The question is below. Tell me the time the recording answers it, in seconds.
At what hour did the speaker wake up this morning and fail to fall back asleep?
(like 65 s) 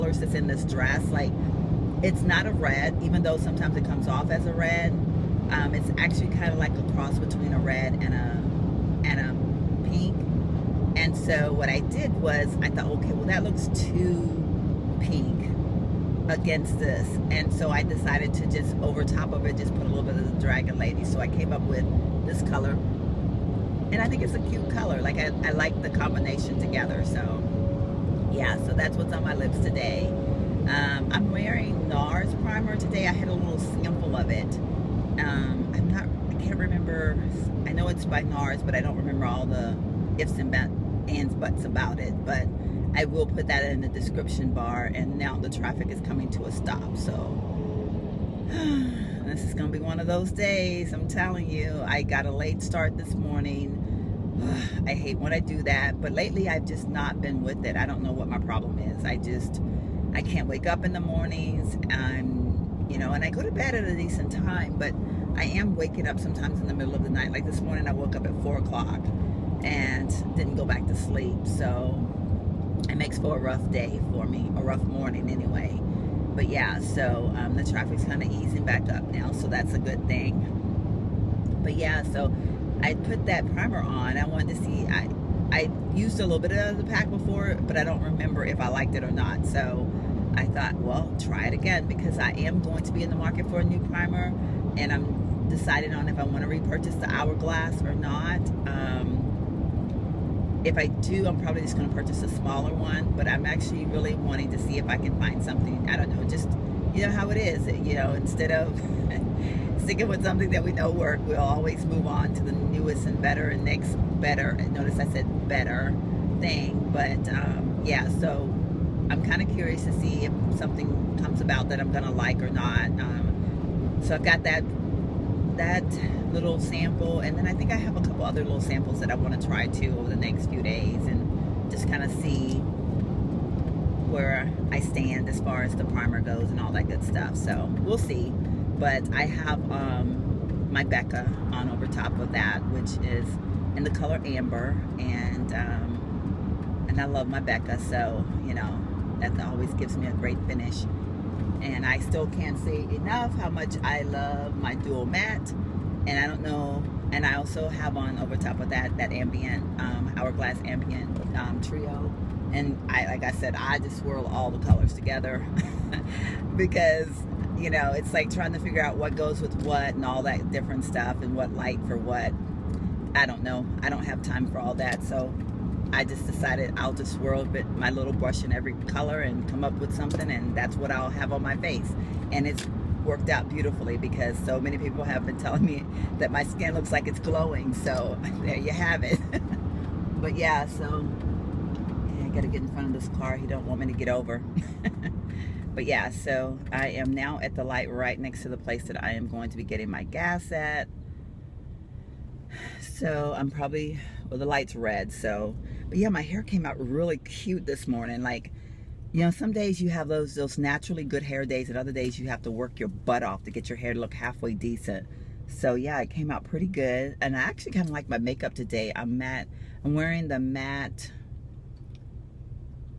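68 s.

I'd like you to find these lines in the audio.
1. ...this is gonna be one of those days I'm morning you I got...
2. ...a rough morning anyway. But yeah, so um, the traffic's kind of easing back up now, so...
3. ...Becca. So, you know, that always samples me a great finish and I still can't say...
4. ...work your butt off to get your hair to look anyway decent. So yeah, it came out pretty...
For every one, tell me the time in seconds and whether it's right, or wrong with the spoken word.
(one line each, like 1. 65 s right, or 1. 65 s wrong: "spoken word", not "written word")
1. 49 s wrong: "telling", not "morning"
2. 74 s right
3. 147 s wrong: "gives", not "samples"
4. 212 s wrong: "halfway", not "anyway".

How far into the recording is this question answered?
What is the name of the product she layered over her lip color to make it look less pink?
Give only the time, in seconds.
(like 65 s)
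20 s.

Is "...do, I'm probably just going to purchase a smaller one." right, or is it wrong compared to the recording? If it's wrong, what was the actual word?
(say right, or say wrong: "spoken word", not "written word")
right.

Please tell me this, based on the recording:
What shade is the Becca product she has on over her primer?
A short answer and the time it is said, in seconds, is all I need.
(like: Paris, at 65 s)
Amber, at 144 s.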